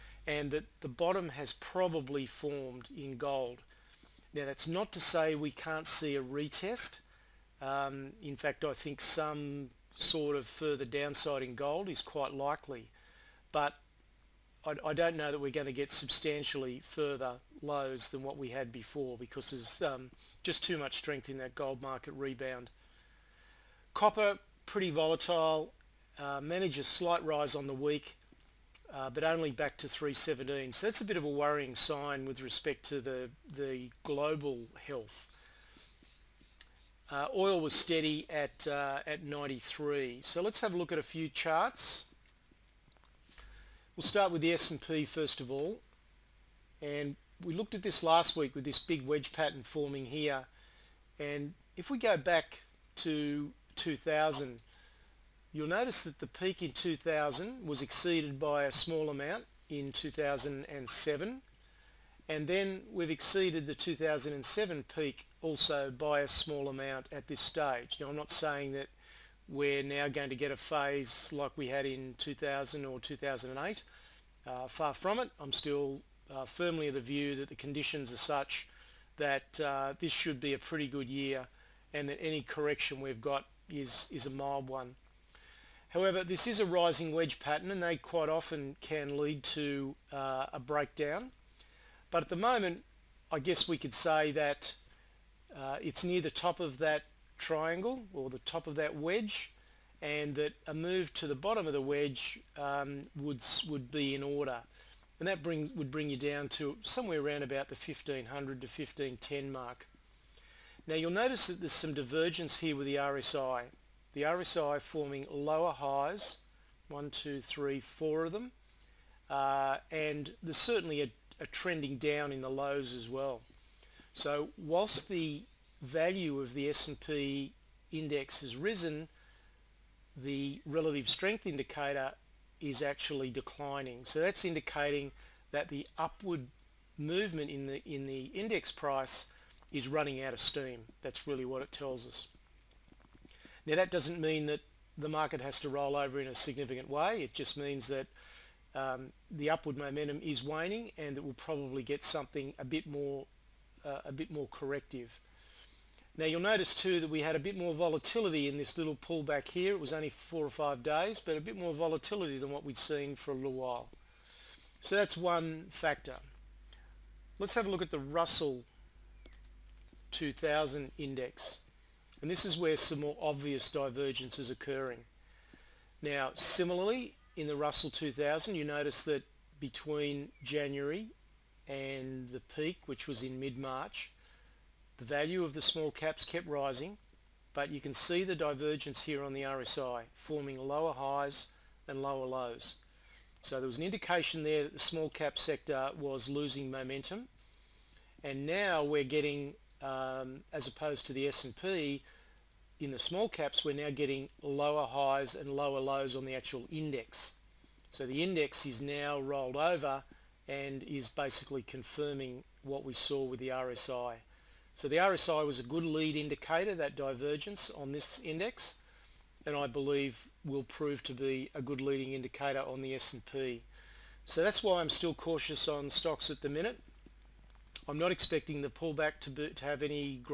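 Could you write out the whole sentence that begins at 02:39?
It was only four or five days, but a bit more volatility than what we'd seen for a little while.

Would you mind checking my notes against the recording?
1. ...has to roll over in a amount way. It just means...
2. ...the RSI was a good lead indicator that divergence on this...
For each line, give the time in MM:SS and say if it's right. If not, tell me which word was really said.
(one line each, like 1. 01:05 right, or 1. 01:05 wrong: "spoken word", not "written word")
1. 02:25 wrong: "significant", not "amount"
2. 03:34 right.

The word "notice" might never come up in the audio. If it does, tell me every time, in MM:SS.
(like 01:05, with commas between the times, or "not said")
00:55, 01:51, 02:36, 02:58.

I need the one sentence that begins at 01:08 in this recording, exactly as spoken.
Now I'm not saying that we're now going to get a phase like we had in 2000 or 2008.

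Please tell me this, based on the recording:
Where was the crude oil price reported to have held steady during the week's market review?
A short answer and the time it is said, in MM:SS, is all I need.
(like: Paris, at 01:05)
93, at 00:39.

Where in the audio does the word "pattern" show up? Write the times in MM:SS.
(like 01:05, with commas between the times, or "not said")
00:49, 01:27.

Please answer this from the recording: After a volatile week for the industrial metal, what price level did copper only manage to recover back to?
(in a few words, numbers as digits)
317.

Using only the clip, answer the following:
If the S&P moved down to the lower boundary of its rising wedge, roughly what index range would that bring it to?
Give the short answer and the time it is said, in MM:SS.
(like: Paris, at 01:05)
1500 to 1510, at 01:47.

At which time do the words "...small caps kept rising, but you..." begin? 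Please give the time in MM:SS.
03:05.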